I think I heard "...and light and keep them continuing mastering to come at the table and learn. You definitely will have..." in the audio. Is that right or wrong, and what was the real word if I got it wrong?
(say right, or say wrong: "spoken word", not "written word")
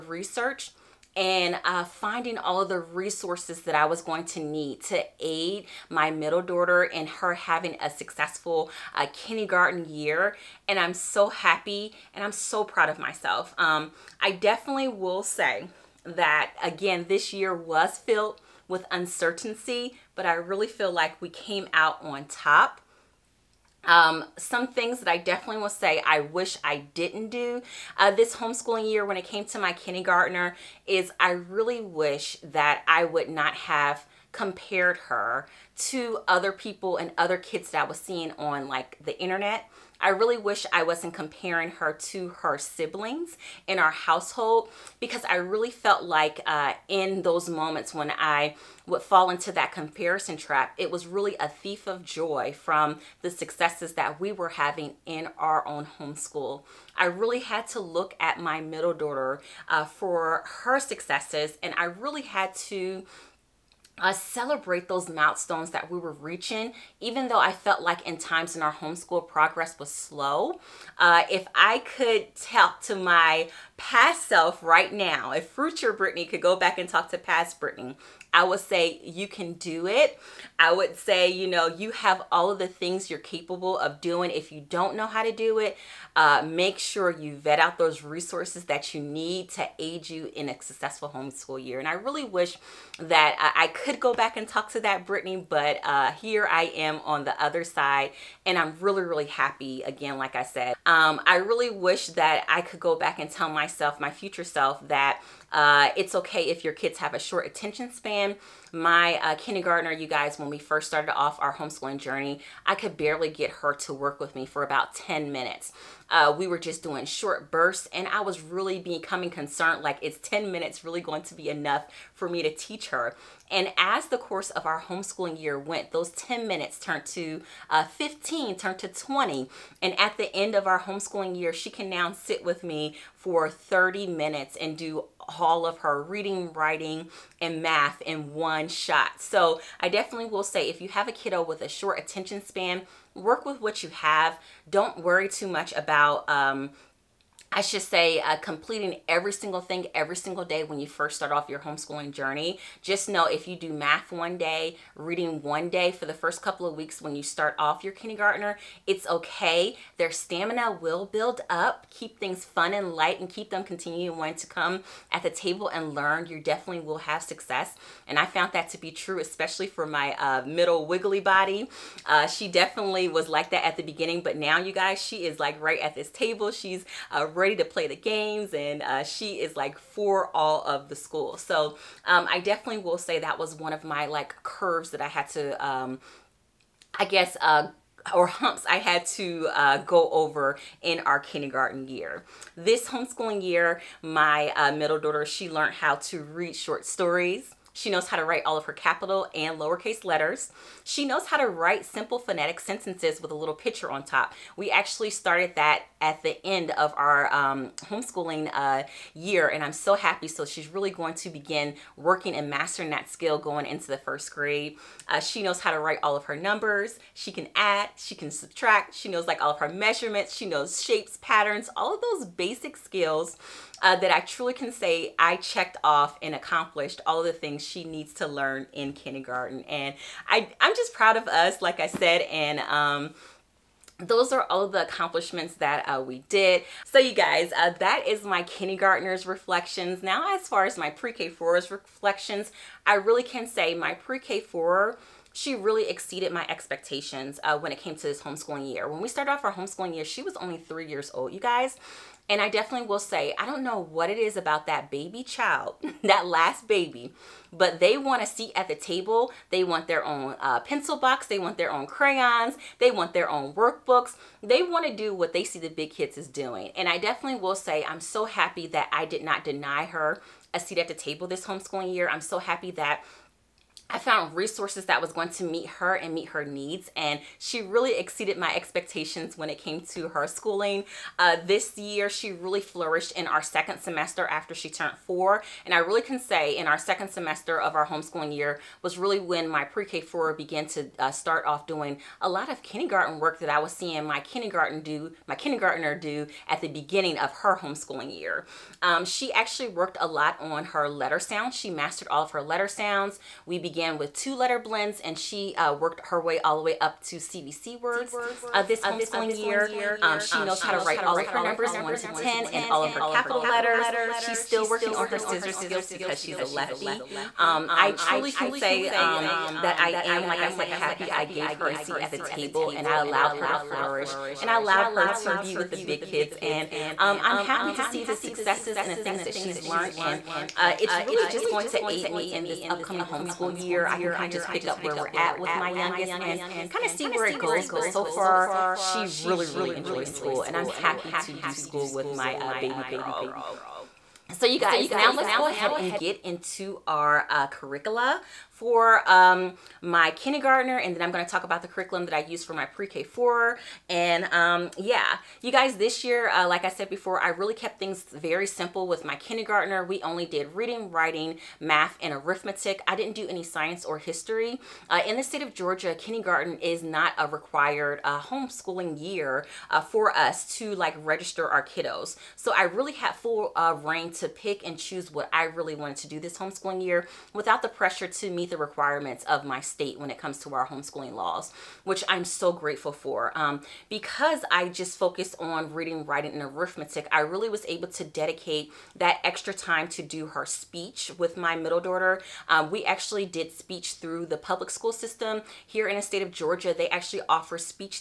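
wrong: "wanting", not "mastering".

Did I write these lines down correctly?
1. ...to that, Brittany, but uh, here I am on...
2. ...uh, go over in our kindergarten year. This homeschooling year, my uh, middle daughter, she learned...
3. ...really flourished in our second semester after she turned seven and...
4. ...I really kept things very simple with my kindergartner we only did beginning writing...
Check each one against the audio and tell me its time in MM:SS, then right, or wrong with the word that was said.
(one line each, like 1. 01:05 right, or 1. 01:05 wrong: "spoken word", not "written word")
1. 01:34 right
2. 03:09 right
3. 04:42 wrong: "four", not "seven"
4. 05:57 wrong: "reading", not "beginning".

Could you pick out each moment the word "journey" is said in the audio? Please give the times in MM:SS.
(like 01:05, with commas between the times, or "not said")
01:51, 02:32.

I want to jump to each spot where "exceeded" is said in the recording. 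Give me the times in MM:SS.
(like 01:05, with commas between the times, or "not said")
04:05, 04:37.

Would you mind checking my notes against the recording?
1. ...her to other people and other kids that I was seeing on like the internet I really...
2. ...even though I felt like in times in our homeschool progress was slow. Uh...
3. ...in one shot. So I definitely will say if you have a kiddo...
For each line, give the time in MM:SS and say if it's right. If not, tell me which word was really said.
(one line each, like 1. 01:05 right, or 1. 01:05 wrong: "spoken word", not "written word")
1. 00:34 right
2. 01:07 right
3. 02:18 right.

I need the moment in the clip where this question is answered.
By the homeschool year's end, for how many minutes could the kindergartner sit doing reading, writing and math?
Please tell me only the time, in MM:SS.
02:13.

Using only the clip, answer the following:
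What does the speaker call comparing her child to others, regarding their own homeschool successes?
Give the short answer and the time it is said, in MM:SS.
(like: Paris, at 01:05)
A thief of joy, at 00:51.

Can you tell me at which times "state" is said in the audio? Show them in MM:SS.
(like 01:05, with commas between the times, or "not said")
06:05, 06:19, 06:36.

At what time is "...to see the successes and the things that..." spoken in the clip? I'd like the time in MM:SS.
05:27.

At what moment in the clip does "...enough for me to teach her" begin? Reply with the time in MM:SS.
02:01.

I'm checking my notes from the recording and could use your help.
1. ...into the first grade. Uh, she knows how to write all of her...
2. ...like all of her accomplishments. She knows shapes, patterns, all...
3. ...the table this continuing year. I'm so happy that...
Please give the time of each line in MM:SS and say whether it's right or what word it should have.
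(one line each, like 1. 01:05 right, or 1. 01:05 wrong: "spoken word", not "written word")
1. 03:33 right
2. 03:39 wrong: "measurements", not "accomplishments"
3. 04:30 wrong: "homeschooling", not "continuing".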